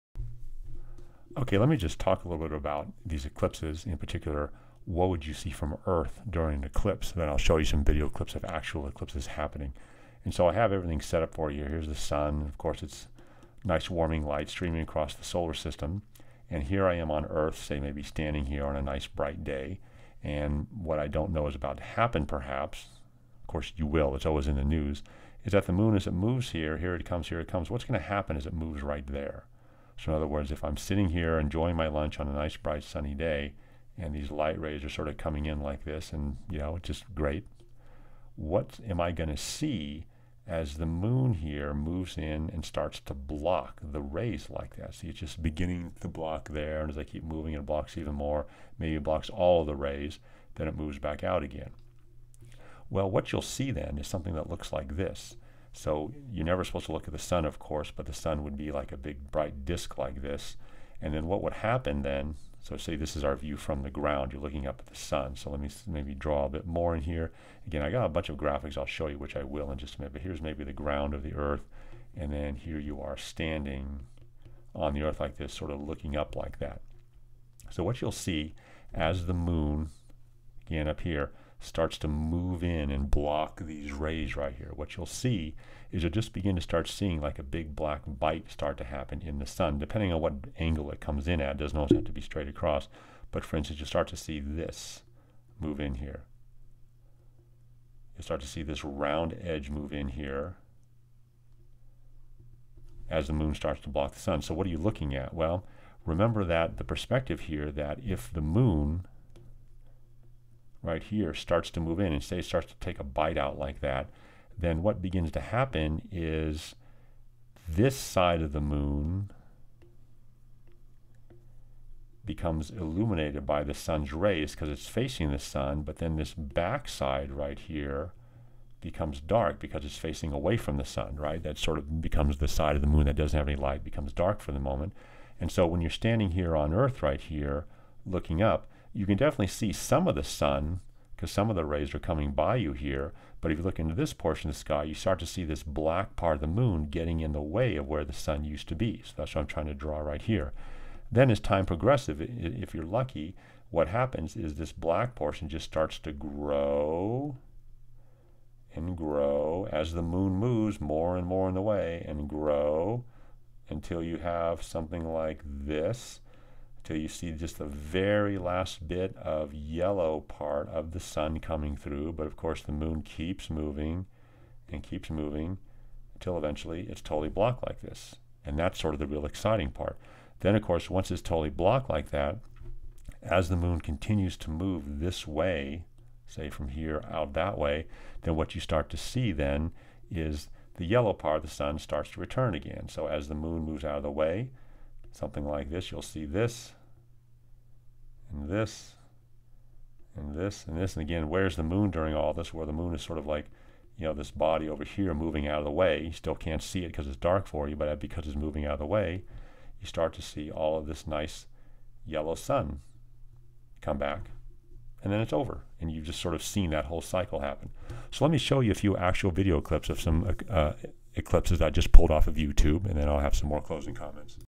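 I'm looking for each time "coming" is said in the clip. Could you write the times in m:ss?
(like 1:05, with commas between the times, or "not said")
0:35, 2:21, 2:51.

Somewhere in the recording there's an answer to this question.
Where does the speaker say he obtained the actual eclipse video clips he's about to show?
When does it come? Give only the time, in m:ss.
3:42.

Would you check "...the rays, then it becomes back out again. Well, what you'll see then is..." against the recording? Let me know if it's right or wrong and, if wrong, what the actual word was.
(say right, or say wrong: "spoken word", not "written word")
wrong: "moves", not "becomes".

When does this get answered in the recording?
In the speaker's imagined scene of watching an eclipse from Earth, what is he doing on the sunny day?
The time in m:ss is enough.
0:31.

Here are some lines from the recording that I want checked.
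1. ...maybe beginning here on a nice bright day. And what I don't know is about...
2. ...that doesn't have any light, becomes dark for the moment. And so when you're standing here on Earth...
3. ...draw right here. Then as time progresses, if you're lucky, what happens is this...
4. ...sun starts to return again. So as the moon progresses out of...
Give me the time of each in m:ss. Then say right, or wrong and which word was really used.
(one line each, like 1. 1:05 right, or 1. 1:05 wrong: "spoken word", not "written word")
1. 0:17 wrong: "standing", not "beginning"
2. 2:13 right
3. 2:29 right
4. 3:11 wrong: "moves", not "progresses".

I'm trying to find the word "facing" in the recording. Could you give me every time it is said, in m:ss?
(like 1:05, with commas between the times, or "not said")
2:04, 2:09.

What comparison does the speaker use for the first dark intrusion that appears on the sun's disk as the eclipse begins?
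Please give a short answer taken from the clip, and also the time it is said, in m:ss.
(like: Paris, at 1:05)
a big black bite, at 1:27.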